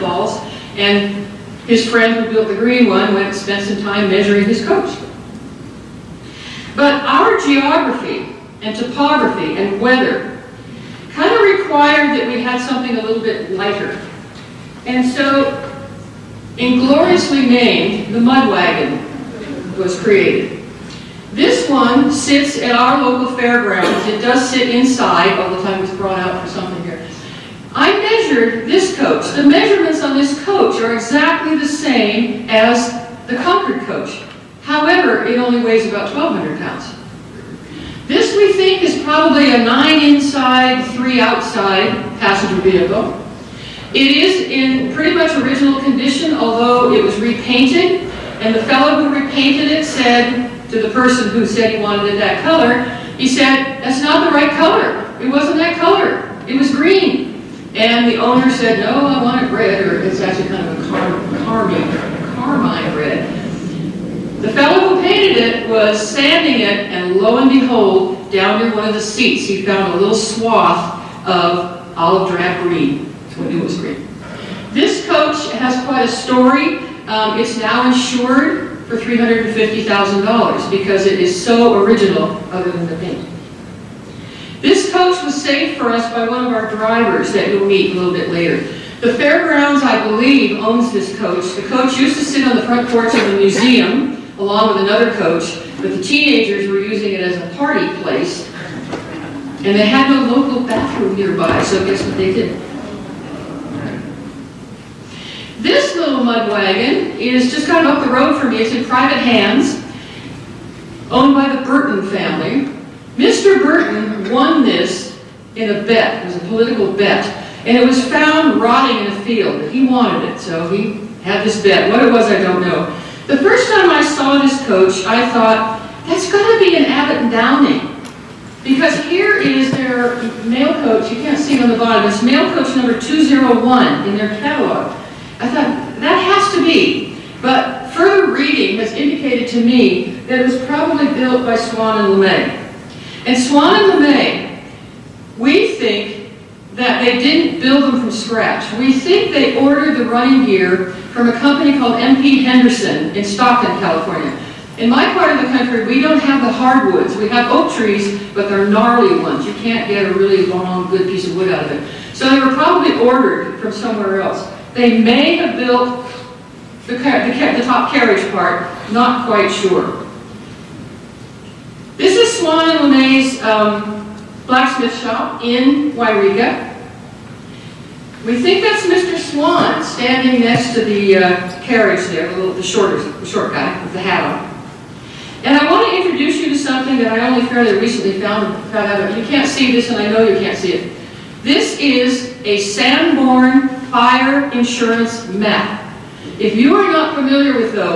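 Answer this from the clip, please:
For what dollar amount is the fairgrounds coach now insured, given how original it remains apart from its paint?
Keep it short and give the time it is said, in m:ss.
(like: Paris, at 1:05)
$350,000, at 1:18.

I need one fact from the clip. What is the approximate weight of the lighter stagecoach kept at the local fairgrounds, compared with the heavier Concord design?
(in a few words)
1,200 pounds.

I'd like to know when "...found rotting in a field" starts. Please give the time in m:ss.
1:58.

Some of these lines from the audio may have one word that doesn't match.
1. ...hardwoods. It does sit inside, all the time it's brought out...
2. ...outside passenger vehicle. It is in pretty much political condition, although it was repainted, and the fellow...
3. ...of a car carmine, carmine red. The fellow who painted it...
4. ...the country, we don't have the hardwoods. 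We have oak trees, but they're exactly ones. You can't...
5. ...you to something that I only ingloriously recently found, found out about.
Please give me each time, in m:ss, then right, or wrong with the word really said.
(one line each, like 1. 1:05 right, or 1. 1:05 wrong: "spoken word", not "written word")
1. 0:23 wrong: "fairgrounds", not "hardwoods"
2. 0:41 wrong: "original", not "political"
3. 1:00 right
4. 2:35 wrong: "gnarly", not "exactly"
5. 3:06 wrong: "fairly", not "ingloriously".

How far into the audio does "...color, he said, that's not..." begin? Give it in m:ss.
0:52.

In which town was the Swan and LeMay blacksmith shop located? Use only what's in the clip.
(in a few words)
Yreka.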